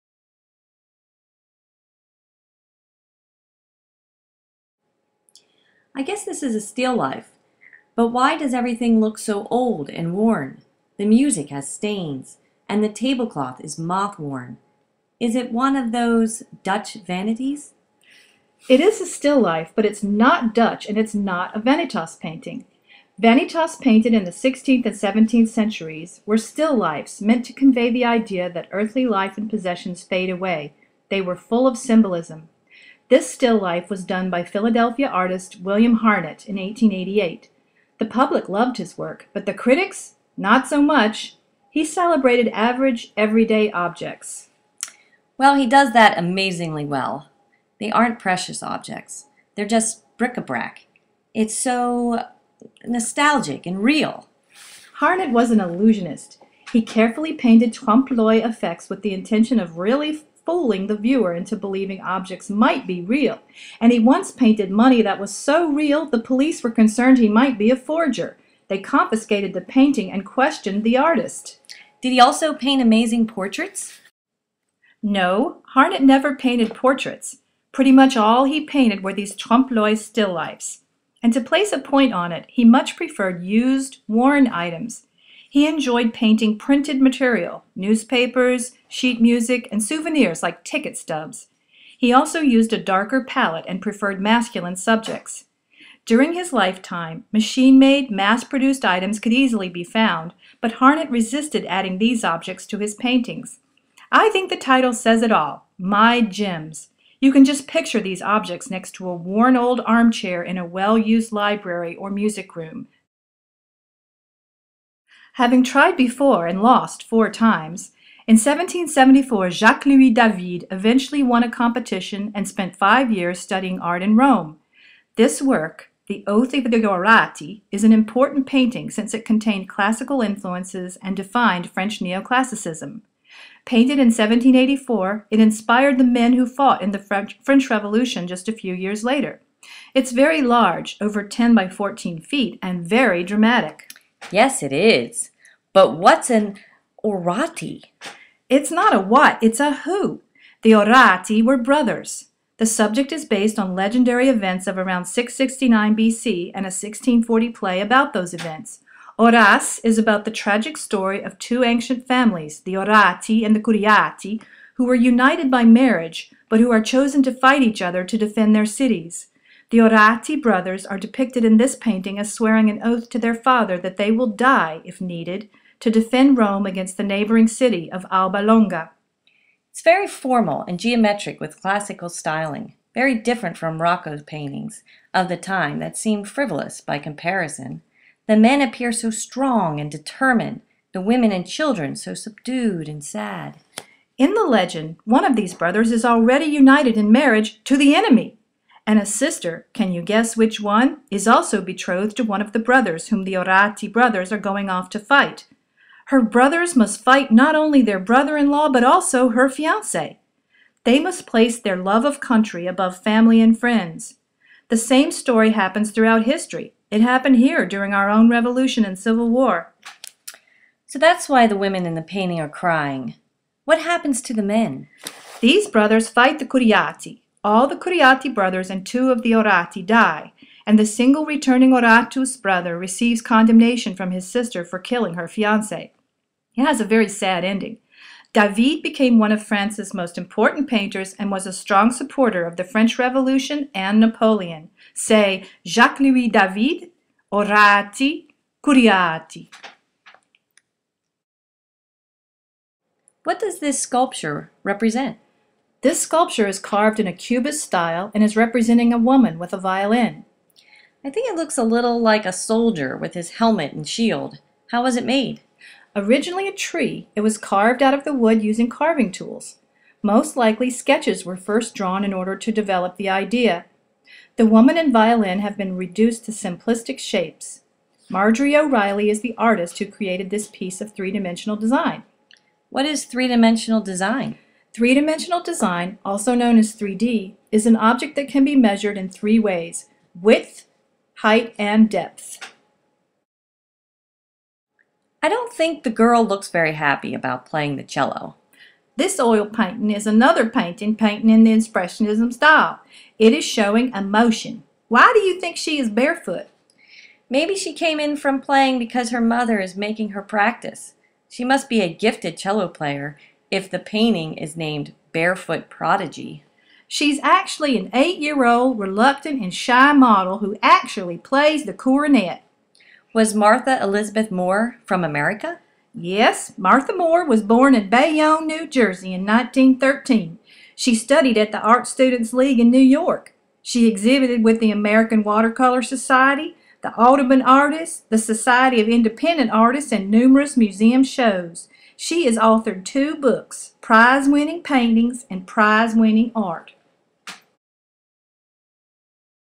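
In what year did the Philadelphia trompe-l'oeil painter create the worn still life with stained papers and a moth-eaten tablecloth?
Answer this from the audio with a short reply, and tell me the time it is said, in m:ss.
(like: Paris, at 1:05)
1888, at 0:36.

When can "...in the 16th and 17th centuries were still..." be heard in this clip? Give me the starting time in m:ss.
0:24.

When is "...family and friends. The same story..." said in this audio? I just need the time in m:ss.
3:33.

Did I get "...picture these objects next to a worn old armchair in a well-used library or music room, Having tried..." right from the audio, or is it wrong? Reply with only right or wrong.
right.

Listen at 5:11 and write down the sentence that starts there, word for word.
She must be a gifted cello player if the painting is named Barefoot Prodigy.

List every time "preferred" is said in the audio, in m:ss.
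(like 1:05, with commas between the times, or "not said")
1:22, 1:33.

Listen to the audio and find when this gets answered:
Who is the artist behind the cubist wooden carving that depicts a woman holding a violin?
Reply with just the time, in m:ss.
4:38.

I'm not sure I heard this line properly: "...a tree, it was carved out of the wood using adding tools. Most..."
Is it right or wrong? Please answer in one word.
wrong.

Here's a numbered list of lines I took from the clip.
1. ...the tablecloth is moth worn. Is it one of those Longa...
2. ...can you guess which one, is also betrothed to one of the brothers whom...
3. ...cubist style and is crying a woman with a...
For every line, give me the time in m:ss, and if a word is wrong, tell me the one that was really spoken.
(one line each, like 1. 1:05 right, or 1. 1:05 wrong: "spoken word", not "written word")
1. 0:12 wrong: "Dutch", not "Longa"
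2. 3:19 right
3. 4:17 wrong: "representing", not "crying".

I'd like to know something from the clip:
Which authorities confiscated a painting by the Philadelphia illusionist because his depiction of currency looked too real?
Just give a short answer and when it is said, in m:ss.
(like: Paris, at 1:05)
The police, at 1:06.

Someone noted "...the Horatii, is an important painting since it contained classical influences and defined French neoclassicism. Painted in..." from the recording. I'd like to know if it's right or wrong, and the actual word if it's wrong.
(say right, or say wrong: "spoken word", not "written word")
right.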